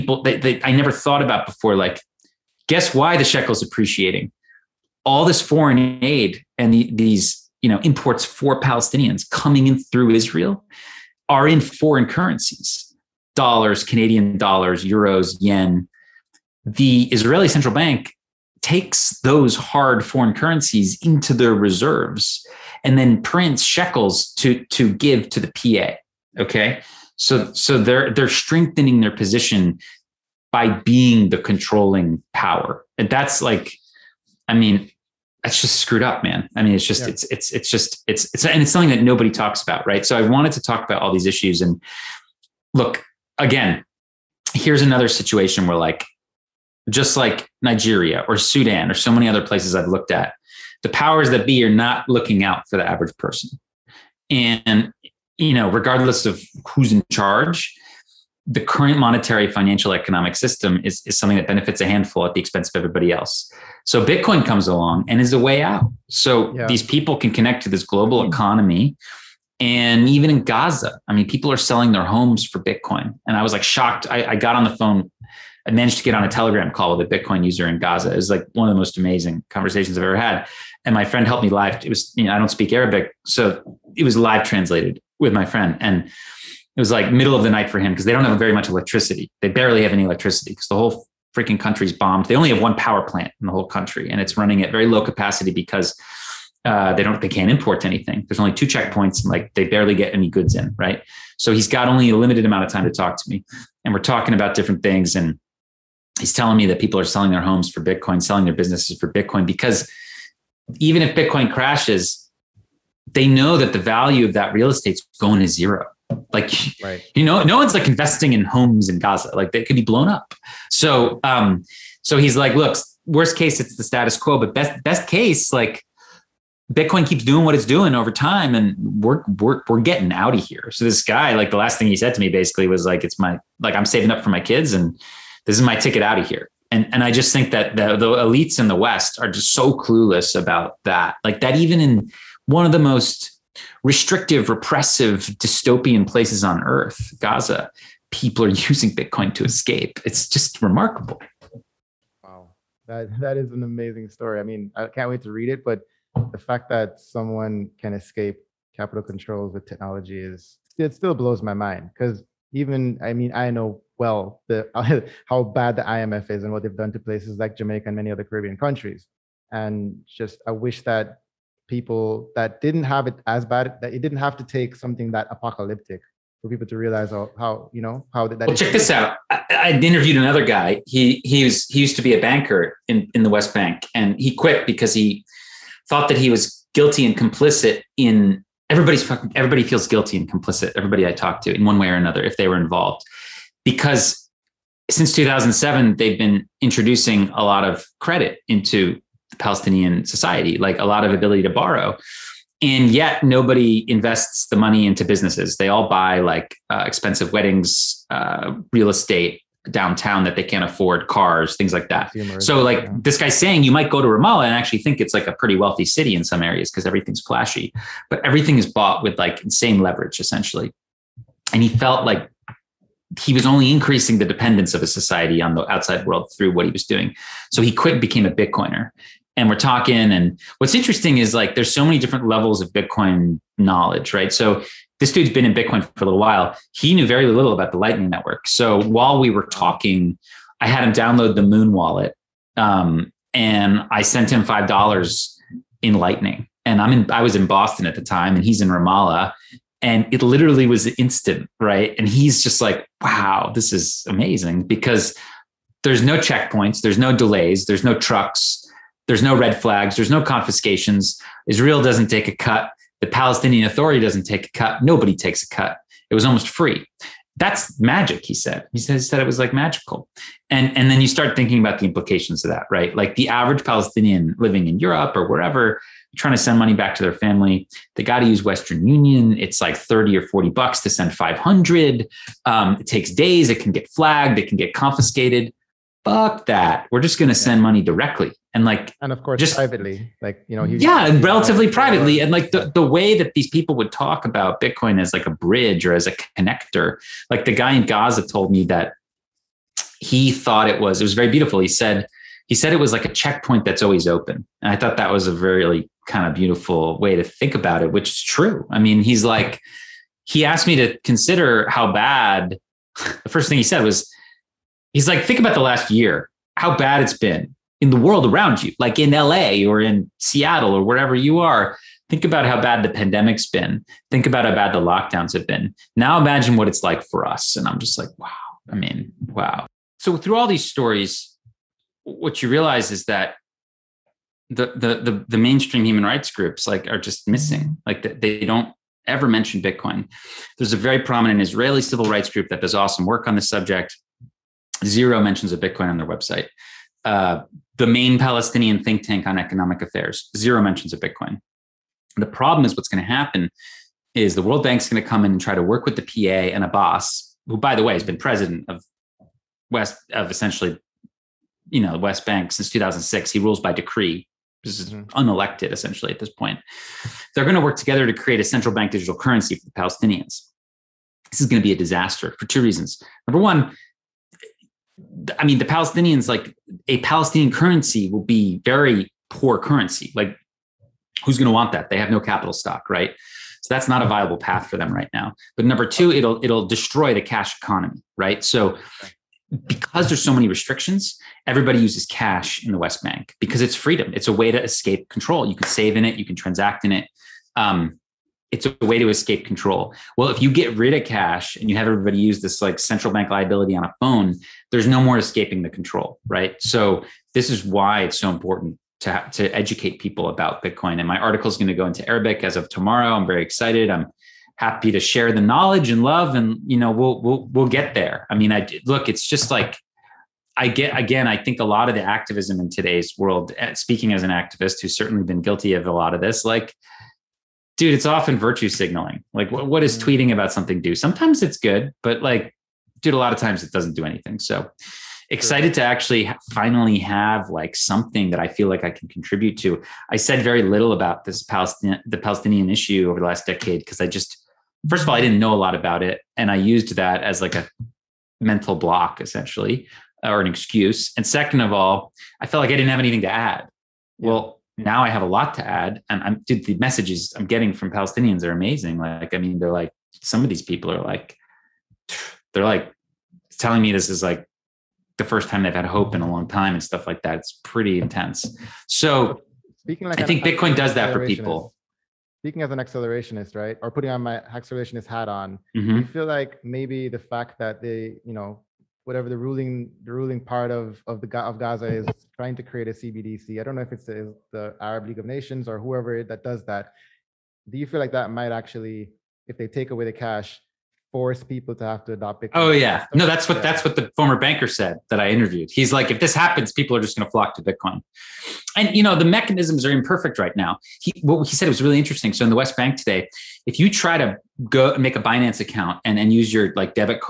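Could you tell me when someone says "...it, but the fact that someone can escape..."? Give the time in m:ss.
2:35.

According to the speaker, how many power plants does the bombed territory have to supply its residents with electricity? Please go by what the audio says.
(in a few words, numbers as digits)
1.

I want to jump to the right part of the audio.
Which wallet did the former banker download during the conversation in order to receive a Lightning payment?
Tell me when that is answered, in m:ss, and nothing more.
4:01.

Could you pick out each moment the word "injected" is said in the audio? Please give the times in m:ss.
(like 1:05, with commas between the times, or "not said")
not said.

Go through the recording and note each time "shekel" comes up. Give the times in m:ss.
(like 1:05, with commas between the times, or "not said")
0:03, 0:23.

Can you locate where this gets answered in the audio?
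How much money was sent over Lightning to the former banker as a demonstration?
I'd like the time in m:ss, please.
4:04.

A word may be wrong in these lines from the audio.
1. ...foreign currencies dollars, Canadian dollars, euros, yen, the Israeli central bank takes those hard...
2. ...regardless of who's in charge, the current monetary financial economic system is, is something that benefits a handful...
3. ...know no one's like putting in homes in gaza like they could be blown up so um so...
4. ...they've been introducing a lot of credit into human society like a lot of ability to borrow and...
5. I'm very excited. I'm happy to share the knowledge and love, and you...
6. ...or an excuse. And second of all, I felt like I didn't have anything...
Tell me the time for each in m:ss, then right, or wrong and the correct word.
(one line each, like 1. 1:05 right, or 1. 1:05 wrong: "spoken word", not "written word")
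1. 0:11 right
2. 0:55 right
3. 1:57 wrong: "investing", not "putting"
4. 3:15 wrong: "palestinian", not "human"
5. 6:53 right
6. 7:30 right.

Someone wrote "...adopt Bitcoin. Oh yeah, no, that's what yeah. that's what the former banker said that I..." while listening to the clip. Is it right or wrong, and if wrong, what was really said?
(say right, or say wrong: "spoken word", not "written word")
right.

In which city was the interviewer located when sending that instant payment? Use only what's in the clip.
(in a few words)
Boston.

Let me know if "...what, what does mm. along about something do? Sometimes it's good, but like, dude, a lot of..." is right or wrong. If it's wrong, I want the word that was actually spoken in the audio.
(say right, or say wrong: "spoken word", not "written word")
wrong: "tweeting", not "along".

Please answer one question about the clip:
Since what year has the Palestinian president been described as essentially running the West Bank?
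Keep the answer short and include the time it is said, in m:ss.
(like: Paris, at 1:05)
2006, at 6:02.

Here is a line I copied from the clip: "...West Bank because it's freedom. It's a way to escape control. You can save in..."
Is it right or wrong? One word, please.
right.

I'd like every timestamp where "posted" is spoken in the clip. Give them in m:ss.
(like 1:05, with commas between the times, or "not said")
not said.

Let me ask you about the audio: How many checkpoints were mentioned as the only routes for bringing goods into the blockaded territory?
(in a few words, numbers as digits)
2.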